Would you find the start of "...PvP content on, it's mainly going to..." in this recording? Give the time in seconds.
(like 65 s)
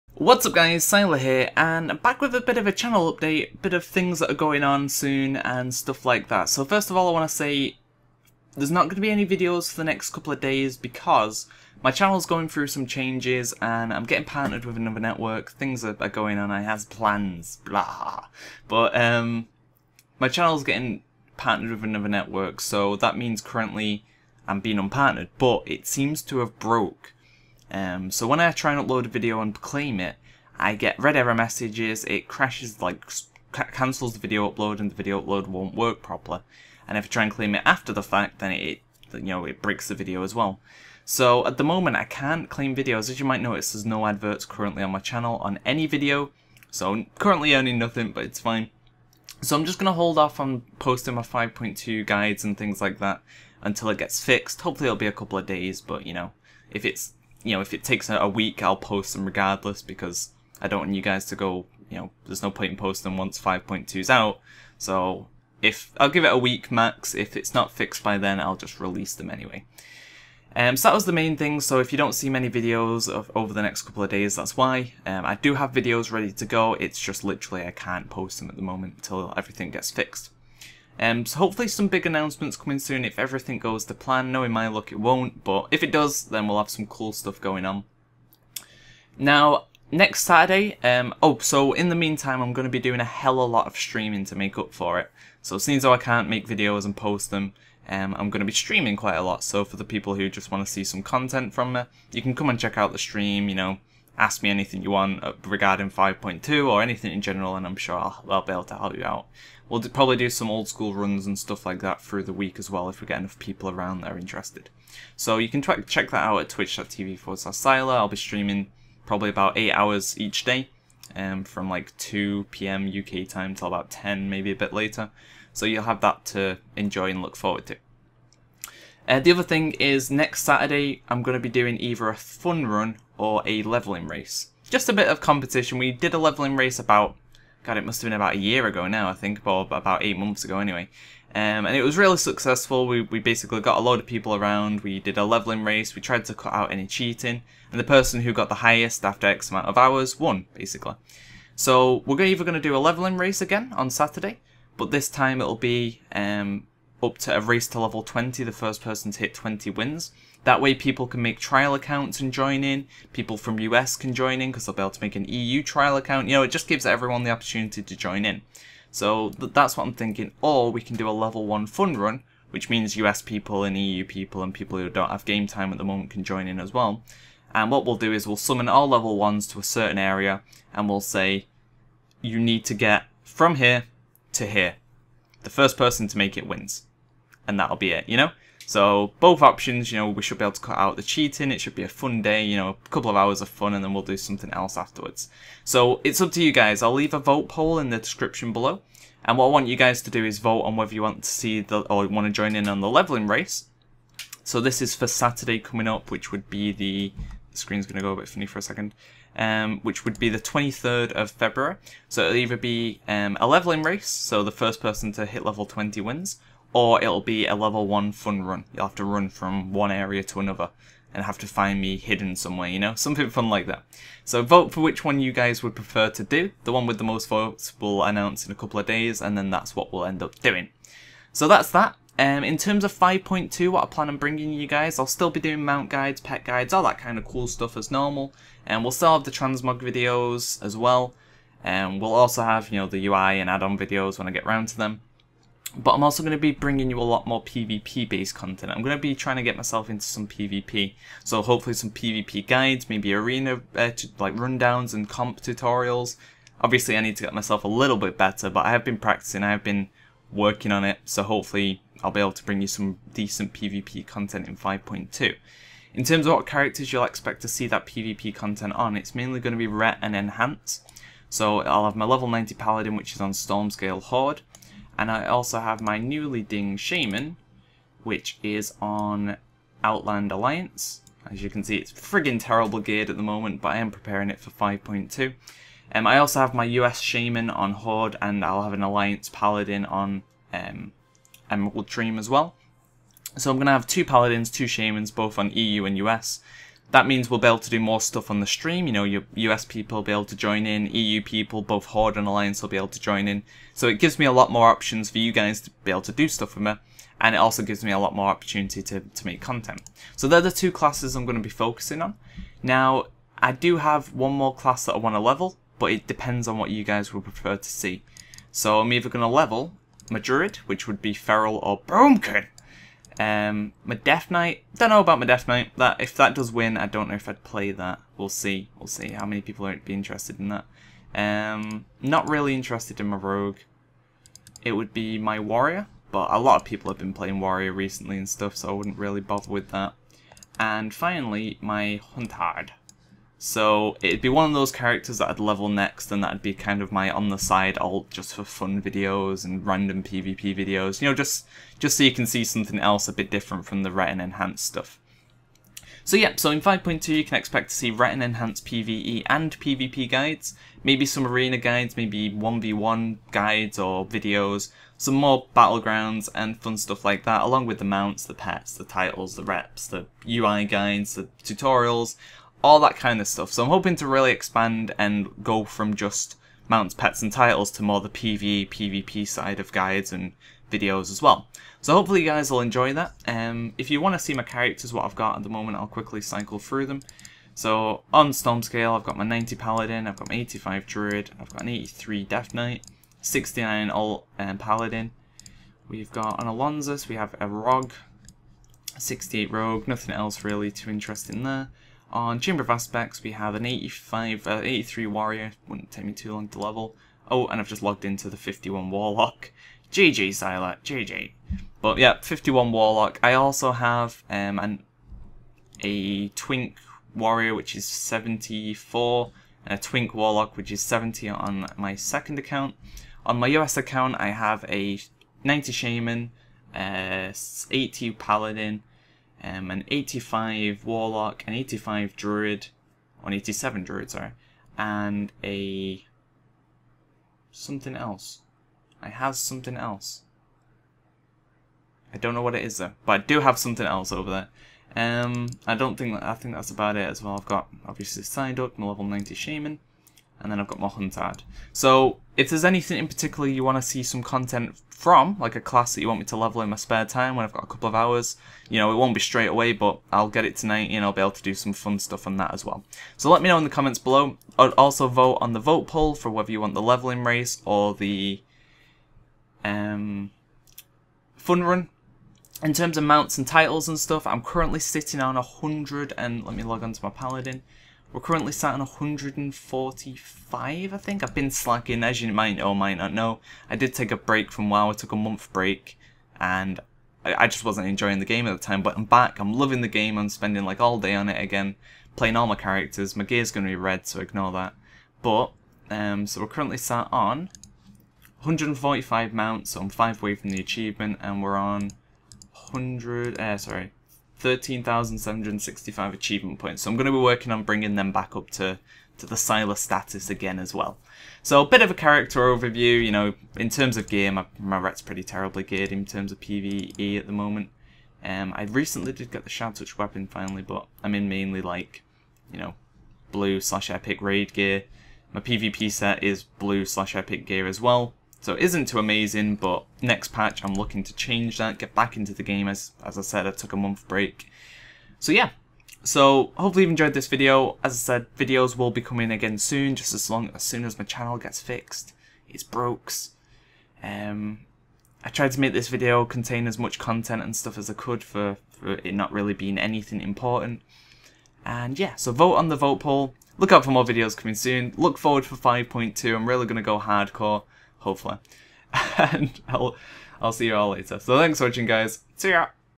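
267 s.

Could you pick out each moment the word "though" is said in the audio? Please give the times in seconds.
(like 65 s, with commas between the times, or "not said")
95 s, 442 s.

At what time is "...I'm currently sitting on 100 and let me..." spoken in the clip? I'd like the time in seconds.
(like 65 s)
474 s.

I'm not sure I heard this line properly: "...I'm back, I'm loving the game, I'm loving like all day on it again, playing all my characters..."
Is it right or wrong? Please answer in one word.
wrong.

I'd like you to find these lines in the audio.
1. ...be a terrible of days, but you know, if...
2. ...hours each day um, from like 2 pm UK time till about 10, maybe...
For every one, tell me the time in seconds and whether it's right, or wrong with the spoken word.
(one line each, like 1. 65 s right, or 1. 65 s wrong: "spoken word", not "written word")
1. 54 s wrong: "couple", not "terrible"
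2. 119 s right.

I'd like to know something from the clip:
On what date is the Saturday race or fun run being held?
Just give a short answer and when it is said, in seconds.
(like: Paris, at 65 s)
23rd of February, at 210 s.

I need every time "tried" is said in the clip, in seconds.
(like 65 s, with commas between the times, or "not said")
146 s, 545 s.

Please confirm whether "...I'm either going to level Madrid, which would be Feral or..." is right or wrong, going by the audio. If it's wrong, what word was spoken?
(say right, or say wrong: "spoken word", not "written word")
right.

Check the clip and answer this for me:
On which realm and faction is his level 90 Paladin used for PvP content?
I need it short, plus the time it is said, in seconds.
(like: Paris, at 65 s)
Stormscale Horde, at 273 s.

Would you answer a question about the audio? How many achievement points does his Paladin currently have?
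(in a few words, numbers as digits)
13,765.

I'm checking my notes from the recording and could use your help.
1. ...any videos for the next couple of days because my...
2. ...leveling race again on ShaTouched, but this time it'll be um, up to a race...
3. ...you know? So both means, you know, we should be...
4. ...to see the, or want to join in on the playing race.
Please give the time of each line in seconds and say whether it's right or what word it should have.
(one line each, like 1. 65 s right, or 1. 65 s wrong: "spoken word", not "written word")
1. 9 s right
2. 152 s wrong: "Saturday", not "ShaTouched"
3. 188 s wrong: "options", not "means"
4. 201 s wrong: "leveling", not "playing".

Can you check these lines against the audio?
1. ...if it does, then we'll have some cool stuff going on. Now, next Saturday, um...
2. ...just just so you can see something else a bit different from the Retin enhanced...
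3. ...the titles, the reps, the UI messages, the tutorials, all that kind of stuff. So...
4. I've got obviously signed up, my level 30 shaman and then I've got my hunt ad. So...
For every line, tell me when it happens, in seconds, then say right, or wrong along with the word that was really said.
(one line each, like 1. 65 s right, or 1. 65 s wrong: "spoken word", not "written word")
1. 85 s right
2. 351 s right
3. 368 s wrong: "guides", not "messages"
4. 447 s wrong: "90", not "30".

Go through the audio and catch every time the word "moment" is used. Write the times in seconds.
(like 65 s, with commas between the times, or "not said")
41 s, 78 s, 175 s, 283 s, 385 s, 517 s.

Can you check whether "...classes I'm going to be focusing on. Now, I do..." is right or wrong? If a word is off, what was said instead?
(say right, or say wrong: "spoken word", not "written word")
right.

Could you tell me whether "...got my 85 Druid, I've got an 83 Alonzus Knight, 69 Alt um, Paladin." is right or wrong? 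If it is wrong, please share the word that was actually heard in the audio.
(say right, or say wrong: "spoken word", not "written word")
wrong: "Death", not "Alonzus".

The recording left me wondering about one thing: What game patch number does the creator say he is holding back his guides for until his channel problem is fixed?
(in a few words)
5.2.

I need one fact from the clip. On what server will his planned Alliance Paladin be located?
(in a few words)
Emerald Dream.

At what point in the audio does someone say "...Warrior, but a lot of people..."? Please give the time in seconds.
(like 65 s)
335 s.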